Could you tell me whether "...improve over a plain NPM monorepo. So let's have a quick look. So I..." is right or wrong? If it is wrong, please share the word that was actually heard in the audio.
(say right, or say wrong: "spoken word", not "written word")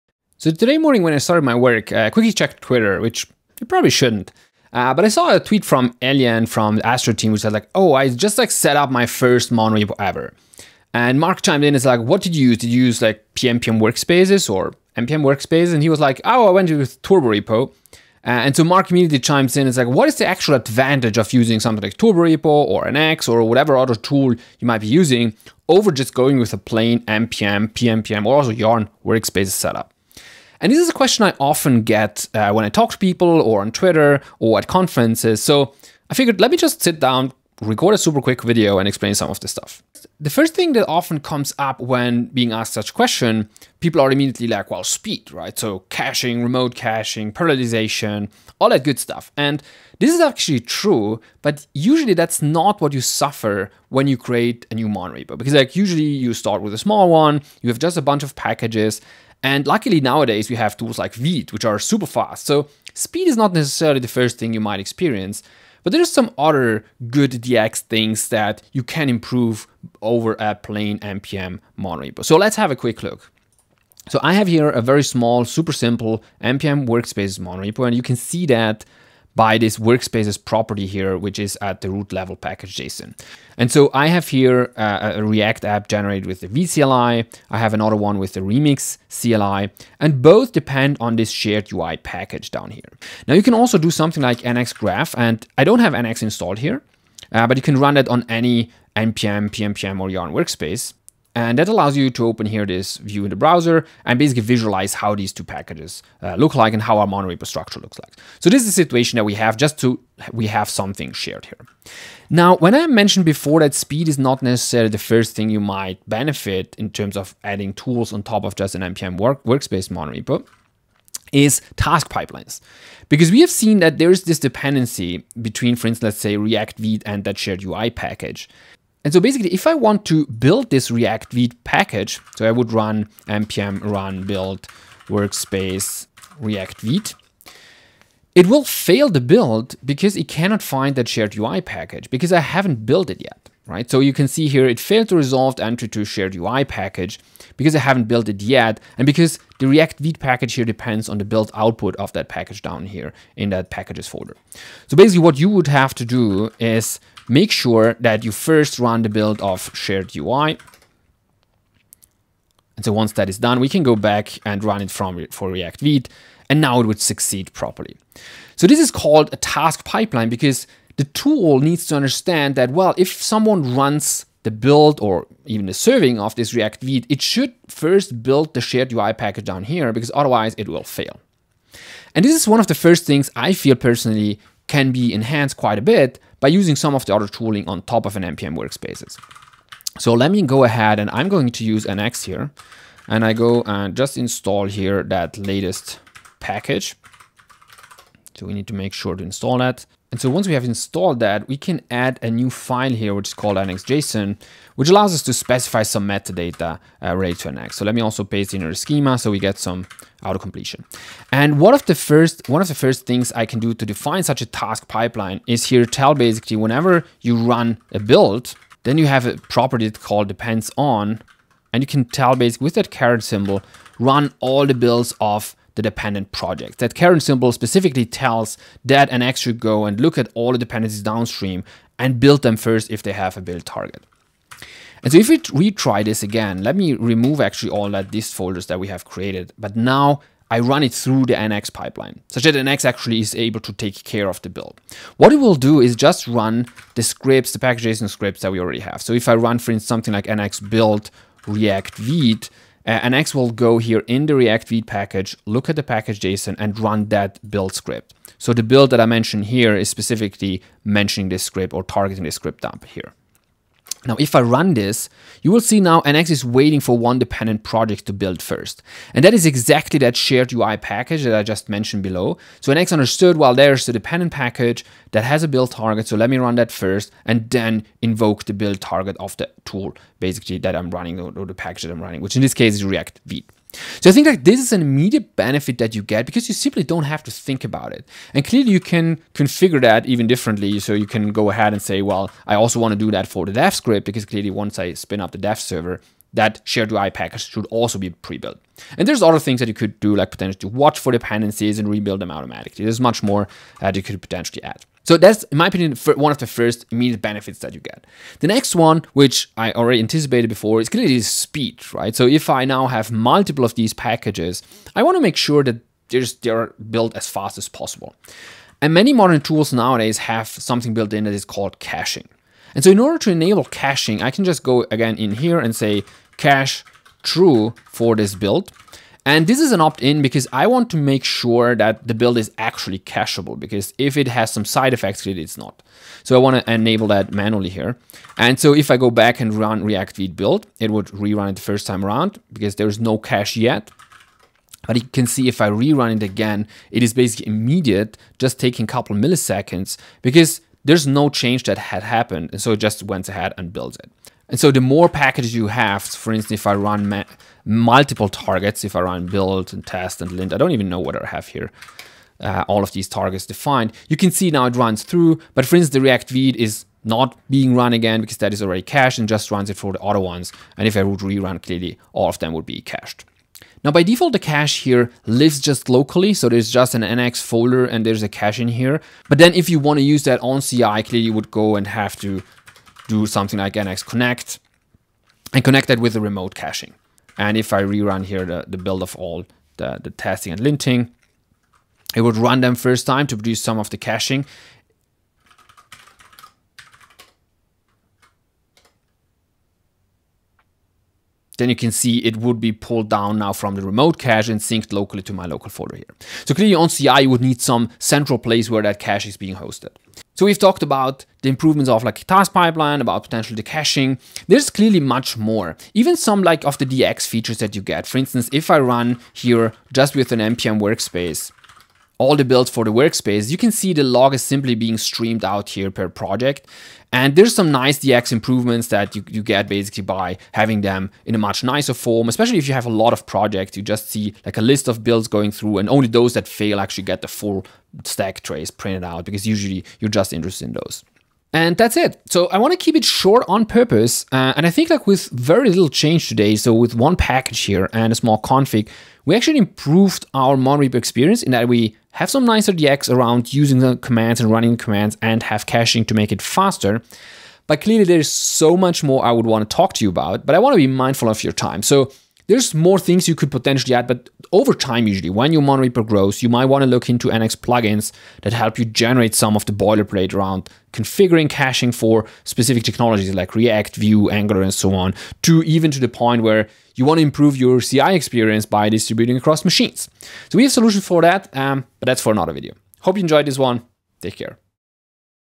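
right.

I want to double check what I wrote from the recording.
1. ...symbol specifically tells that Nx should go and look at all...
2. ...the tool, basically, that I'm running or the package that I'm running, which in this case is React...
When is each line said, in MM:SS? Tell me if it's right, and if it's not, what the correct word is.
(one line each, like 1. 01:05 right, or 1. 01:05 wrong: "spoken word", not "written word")
1. 03:47 right
2. 04:39 right.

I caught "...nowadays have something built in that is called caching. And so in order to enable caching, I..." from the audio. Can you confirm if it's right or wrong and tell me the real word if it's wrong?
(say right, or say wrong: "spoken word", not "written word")
right.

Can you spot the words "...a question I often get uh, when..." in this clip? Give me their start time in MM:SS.
00:30.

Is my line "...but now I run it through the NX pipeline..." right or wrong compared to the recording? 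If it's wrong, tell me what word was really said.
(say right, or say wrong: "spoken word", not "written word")
right.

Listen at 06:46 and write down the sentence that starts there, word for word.
So clearly on CI, you would need some central place where that cache is being hosted.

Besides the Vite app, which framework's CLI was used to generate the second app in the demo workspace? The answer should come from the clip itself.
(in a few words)
Remix.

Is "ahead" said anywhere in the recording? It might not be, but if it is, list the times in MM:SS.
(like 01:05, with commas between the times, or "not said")
03:10, 04:51, 05:53.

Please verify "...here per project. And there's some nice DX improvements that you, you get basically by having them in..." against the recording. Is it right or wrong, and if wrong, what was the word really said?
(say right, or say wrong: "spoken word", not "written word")
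right.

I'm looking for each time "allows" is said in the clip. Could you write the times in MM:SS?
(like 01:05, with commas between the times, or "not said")
01:41, 03:24.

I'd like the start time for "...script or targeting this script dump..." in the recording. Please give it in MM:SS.
04:21.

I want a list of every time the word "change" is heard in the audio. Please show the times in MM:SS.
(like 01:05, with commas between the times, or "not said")
05:51, 07:25.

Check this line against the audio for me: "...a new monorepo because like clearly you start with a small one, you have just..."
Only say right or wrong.
wrong.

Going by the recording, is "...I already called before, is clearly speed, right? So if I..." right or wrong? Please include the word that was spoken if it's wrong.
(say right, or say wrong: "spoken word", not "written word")
wrong: "anticipated", not "called".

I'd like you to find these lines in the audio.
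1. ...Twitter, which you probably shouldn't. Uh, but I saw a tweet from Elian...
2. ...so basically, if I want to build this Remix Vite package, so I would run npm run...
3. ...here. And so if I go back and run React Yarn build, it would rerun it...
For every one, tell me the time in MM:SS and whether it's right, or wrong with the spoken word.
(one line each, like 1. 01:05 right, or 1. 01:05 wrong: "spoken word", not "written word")
1. 00:02 right
2. 02:09 wrong: "React", not "Remix"
3. 05:37 wrong: "Vite", not "Yarn".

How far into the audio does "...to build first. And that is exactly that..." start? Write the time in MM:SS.
04:28.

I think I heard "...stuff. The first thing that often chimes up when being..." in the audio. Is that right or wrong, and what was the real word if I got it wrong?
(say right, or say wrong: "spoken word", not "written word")
wrong: "comes", not "chimes".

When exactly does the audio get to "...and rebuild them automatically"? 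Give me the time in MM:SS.
05:01.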